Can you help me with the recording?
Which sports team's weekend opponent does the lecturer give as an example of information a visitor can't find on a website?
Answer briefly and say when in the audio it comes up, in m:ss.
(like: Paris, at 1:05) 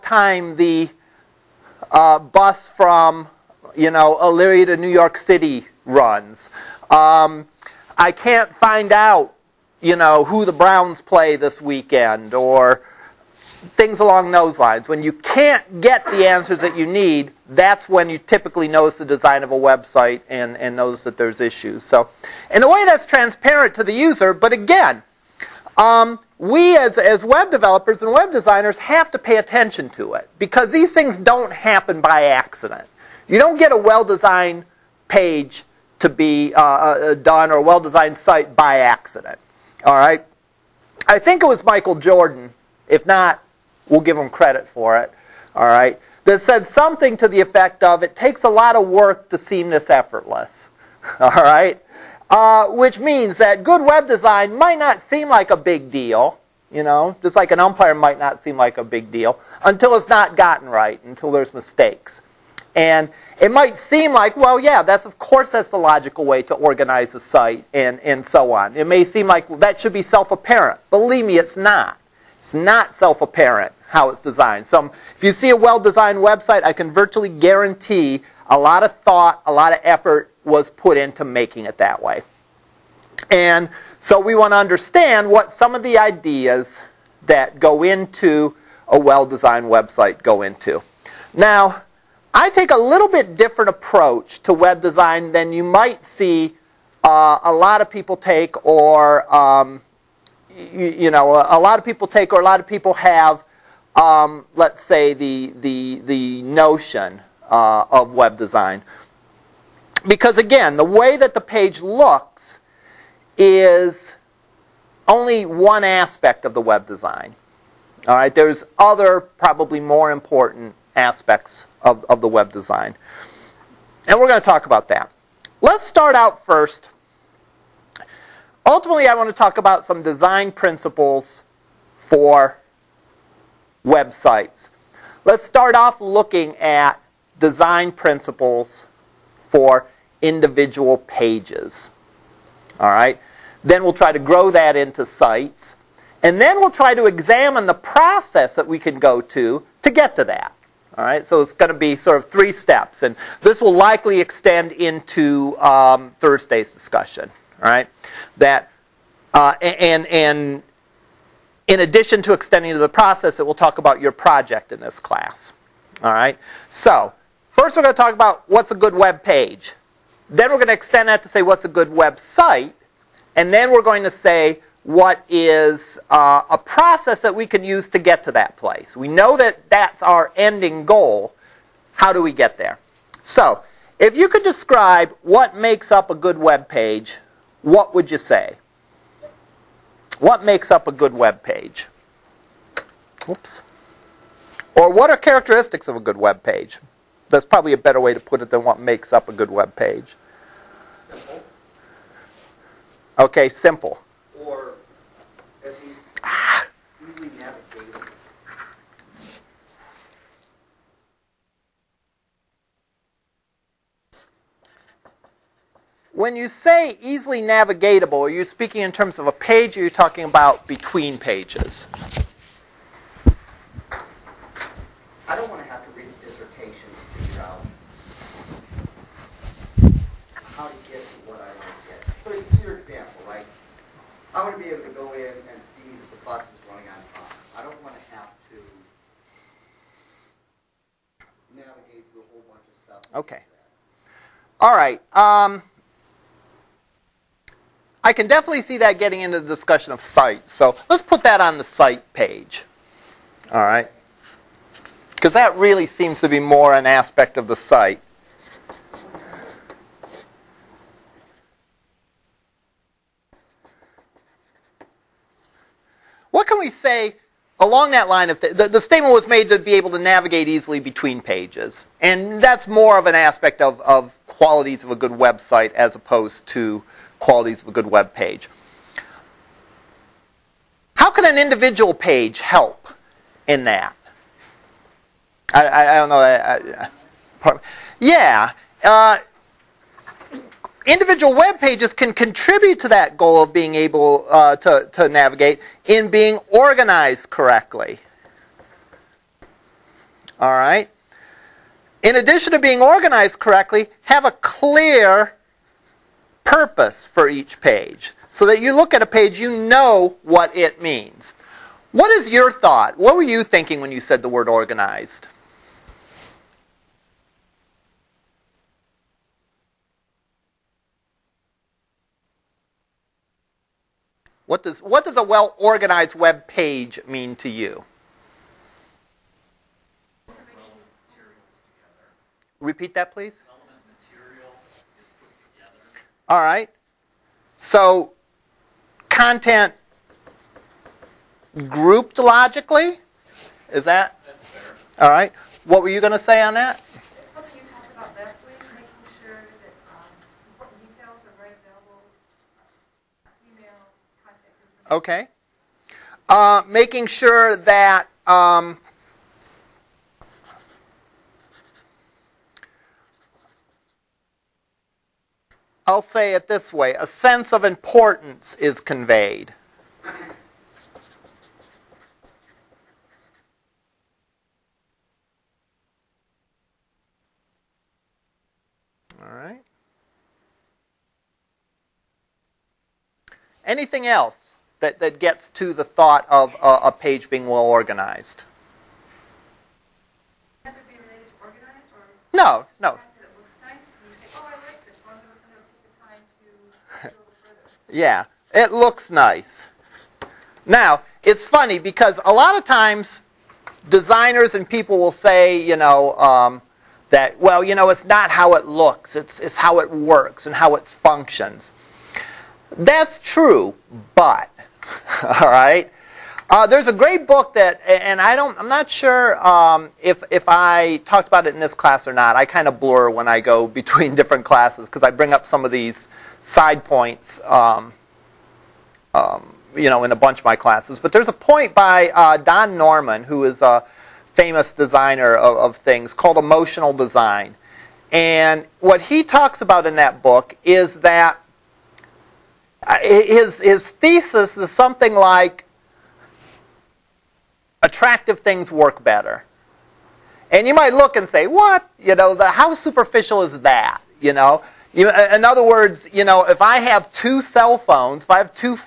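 The Browns, at 0:10.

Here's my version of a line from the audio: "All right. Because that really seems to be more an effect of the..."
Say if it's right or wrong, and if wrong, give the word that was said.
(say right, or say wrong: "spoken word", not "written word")
wrong: "aspect", not "effect".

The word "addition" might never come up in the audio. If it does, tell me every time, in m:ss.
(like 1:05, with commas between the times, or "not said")
2:41, 5:02.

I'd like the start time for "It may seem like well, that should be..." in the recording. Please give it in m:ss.
1:08.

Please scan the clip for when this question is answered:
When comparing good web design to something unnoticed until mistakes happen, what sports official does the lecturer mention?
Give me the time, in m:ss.
0:57.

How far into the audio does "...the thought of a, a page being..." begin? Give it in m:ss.
6:25.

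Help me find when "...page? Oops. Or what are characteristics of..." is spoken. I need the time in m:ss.
3:11.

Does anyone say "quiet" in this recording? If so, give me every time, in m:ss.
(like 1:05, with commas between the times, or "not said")
not said.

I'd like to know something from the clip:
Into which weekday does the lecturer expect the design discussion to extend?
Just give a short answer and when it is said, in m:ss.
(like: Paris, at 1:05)
Thursday, at 2:36.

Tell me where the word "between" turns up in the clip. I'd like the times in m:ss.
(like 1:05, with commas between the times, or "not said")
3:40, 4:30, 7:03.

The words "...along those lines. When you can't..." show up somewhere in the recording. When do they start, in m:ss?
0:13.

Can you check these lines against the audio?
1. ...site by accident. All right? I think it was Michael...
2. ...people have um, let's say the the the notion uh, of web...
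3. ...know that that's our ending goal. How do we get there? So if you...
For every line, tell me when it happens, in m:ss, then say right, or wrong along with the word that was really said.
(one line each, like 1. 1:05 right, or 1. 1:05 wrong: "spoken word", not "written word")
1. 0:38 right
2. 1:42 right
3. 2:59 right.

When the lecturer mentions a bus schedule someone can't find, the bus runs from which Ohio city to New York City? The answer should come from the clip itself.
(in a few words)
Elyria.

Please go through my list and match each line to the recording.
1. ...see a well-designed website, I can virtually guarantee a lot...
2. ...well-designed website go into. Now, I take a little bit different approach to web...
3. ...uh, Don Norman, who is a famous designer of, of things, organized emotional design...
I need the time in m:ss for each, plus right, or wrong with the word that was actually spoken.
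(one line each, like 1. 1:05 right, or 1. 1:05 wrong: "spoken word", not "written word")
1. 1:15 right
2. 1:28 right
3. 7:12 wrong: "called", not "organized".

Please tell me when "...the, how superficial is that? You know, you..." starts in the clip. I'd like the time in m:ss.
7:32.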